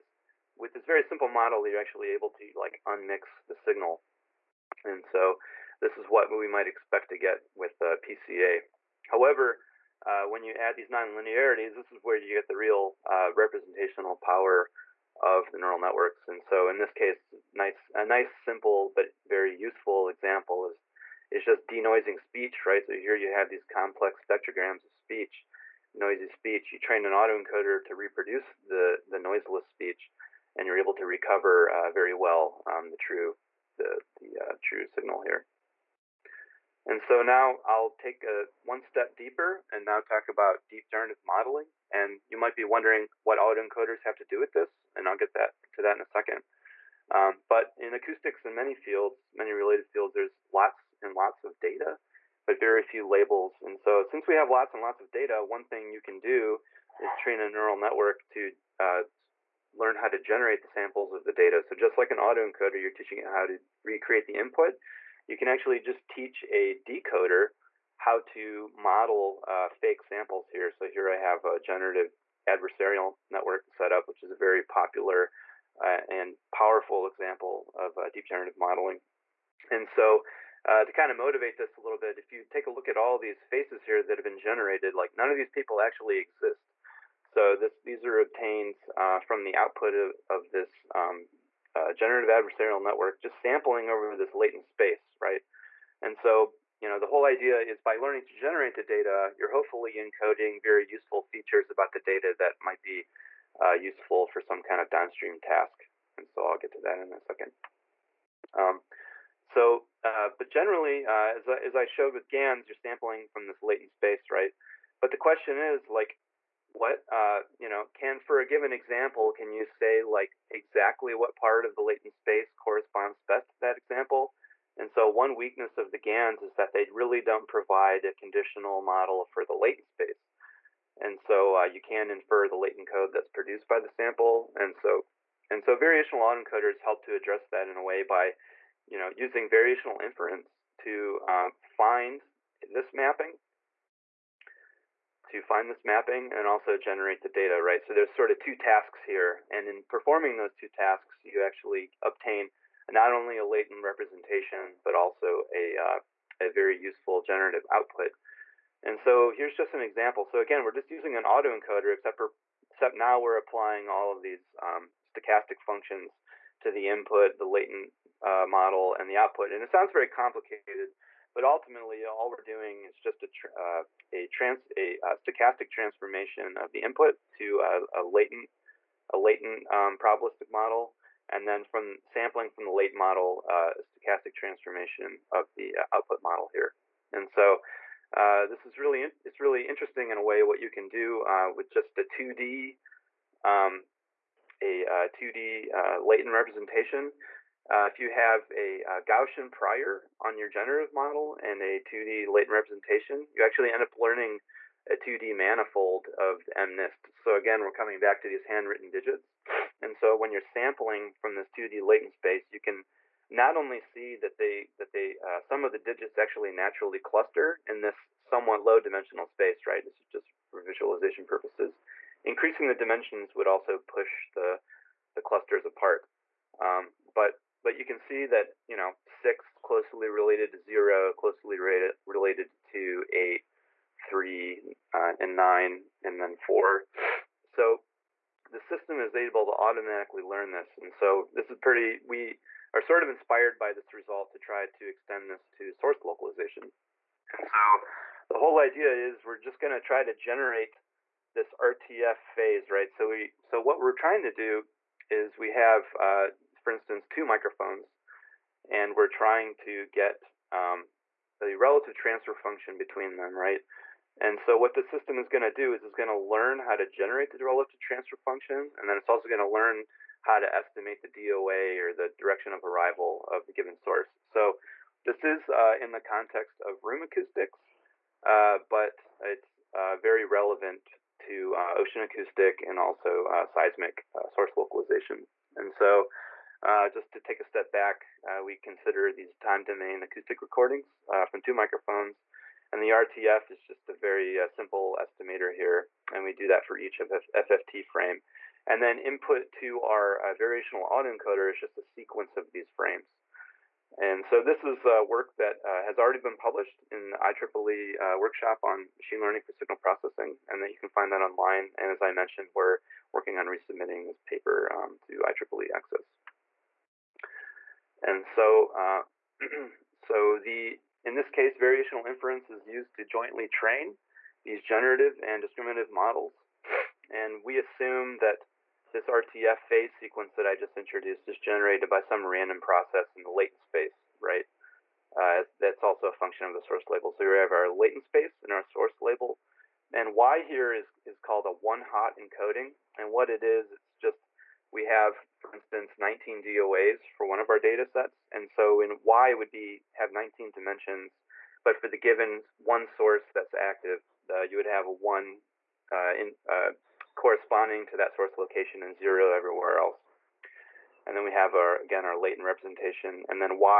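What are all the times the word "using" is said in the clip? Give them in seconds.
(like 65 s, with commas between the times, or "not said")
139 s, 160 s.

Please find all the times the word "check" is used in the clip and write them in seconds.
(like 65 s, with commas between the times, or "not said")
not said.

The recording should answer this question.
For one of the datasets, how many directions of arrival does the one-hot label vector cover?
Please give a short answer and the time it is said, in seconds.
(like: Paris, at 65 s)
19, at 345 s.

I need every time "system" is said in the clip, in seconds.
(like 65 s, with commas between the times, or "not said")
238 s, 264 s.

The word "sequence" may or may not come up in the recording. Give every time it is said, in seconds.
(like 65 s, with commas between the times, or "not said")
301 s, 329 s.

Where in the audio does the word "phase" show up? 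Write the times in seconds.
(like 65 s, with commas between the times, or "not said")
252 s, 329 s.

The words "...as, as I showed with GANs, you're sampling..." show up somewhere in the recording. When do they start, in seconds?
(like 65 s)
111 s.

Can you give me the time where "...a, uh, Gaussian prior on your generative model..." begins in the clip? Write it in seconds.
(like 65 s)
198 s.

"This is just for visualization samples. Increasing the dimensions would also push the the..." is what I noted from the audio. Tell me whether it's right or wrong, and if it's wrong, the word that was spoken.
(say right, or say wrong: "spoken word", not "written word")
wrong: "purposes", not "samples".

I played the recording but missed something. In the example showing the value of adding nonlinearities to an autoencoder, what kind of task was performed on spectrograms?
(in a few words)
Denoising speech.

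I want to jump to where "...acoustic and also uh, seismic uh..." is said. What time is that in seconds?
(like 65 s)
282 s.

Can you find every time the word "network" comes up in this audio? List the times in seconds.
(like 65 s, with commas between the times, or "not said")
15 s, 57 s, 73 s, 92 s.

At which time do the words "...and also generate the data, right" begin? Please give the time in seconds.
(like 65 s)
146 s.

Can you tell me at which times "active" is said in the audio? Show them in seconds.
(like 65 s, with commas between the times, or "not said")
353 s.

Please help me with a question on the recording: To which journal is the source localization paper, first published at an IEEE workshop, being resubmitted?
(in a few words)
IEEE Access.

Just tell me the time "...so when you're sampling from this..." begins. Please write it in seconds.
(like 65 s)
209 s.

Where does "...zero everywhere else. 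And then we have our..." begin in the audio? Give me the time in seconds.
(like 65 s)
358 s.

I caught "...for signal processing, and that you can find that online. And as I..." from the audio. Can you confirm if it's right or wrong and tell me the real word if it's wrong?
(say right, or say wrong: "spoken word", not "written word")
right.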